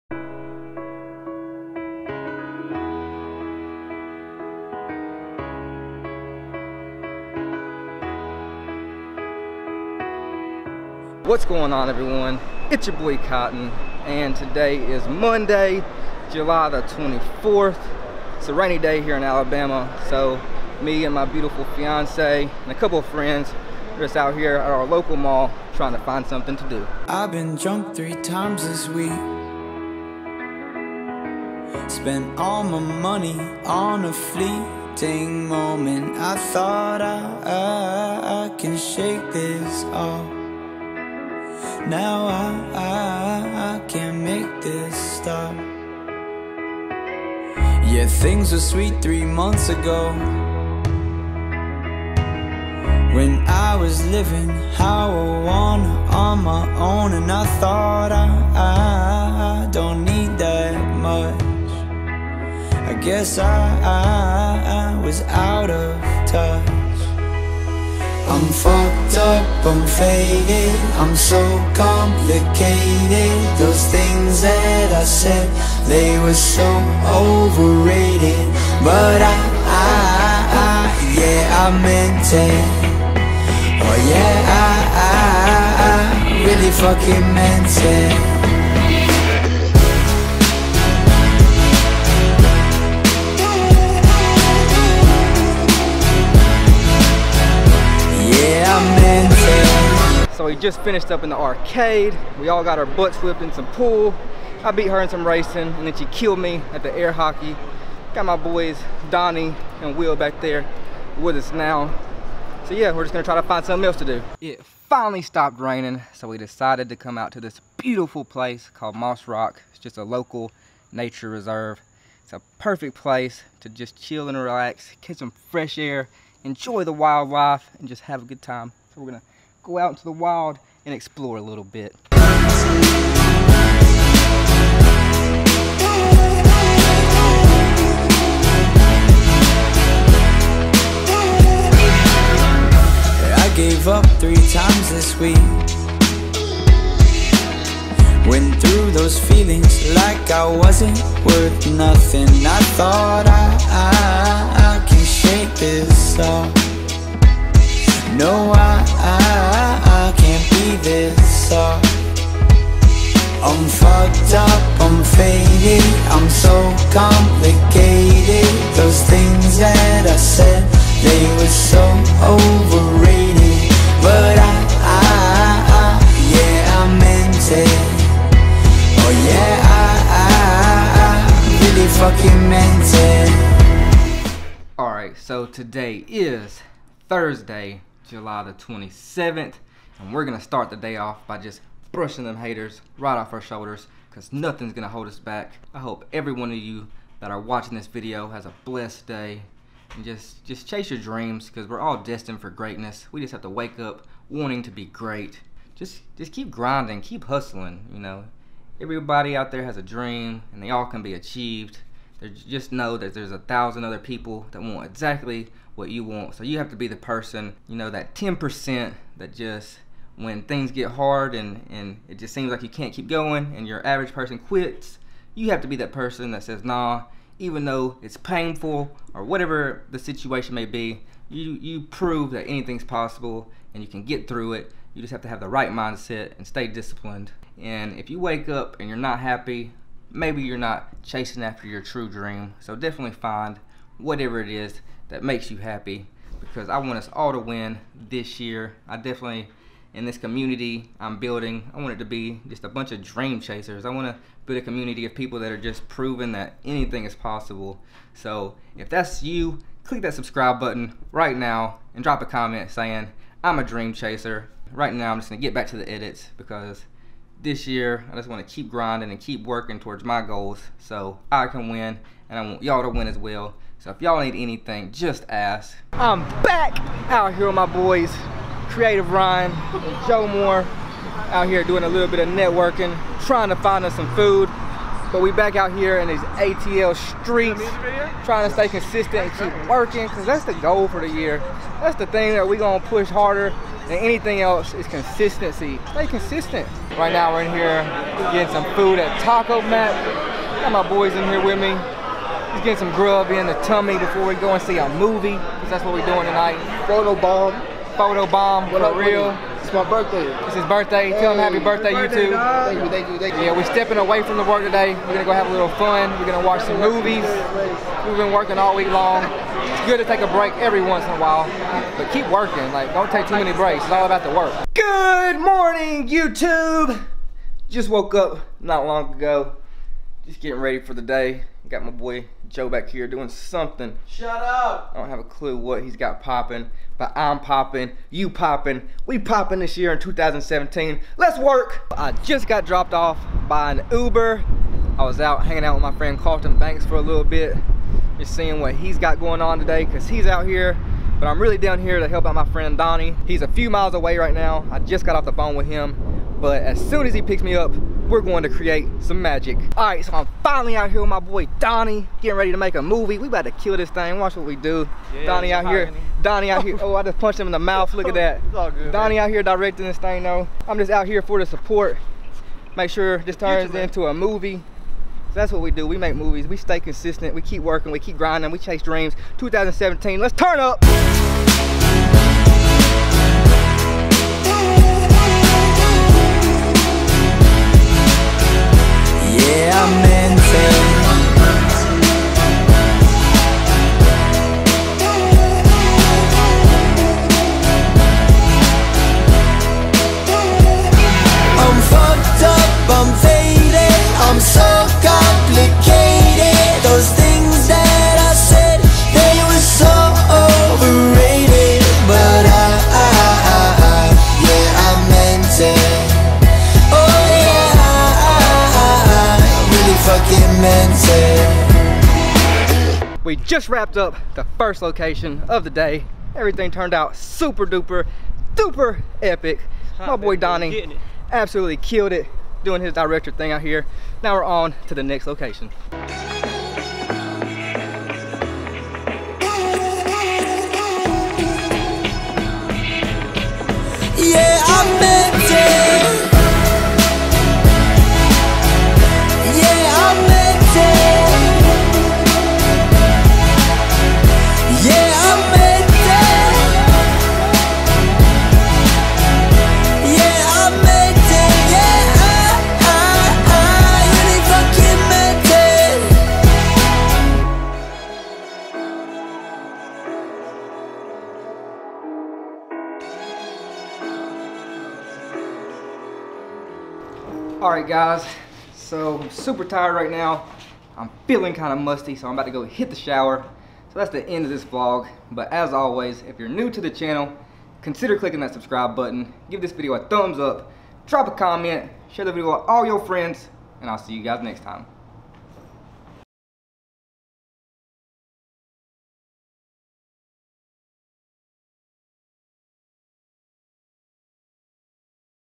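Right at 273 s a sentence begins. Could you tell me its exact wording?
So if y'all need anything, just ask.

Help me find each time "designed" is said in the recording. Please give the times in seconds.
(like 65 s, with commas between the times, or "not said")
not said.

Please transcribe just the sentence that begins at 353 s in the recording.
He's a few miles away right now.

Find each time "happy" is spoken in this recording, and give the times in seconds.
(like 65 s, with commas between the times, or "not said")
239 s, 245 s, 311 s.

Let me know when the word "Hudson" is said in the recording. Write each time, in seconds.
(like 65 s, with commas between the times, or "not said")
not said.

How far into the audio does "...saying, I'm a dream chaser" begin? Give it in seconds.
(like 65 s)
262 s.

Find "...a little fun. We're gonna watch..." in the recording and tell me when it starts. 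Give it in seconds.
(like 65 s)
315 s.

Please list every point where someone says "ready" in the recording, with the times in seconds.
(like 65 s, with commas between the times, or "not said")
330 s, 362 s.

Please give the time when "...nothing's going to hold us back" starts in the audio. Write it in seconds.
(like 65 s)
194 s.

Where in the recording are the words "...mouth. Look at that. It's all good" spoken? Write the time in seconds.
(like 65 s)
367 s.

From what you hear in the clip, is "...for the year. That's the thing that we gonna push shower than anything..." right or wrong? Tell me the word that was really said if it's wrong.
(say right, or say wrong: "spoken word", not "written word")
wrong: "harder", not "shower".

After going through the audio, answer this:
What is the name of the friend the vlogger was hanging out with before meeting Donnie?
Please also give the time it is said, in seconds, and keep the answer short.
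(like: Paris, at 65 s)
Carlton Banks, at 346 s.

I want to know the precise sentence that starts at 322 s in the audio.
Like, don't take too many breaks.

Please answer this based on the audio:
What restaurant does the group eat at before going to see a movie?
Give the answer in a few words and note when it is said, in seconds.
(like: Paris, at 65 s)
Taco Mac, at 299 s.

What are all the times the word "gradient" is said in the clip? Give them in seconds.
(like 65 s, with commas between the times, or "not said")
not said.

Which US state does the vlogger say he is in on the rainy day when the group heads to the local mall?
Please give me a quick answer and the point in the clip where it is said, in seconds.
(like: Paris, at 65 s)
Alabama, at 19 s.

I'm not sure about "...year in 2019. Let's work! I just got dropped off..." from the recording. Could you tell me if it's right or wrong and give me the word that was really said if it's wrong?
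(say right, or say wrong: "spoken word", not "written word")
wrong: "2017", not "2019".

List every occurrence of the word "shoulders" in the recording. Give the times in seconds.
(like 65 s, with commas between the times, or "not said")
193 s.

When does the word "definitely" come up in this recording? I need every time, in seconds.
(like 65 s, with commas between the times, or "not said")
242 s, 248 s.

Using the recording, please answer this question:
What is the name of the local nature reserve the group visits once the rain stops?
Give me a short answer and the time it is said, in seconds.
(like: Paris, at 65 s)
Moss Rock, at 118 s.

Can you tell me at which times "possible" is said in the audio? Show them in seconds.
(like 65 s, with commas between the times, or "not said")
232 s, 257 s.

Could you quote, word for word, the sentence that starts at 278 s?
Creative Ryan, and Joe Moore, out here doing a little bit of networking, trying to find us some food.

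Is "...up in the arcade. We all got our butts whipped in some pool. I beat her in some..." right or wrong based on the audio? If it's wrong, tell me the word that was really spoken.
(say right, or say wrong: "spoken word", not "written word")
right.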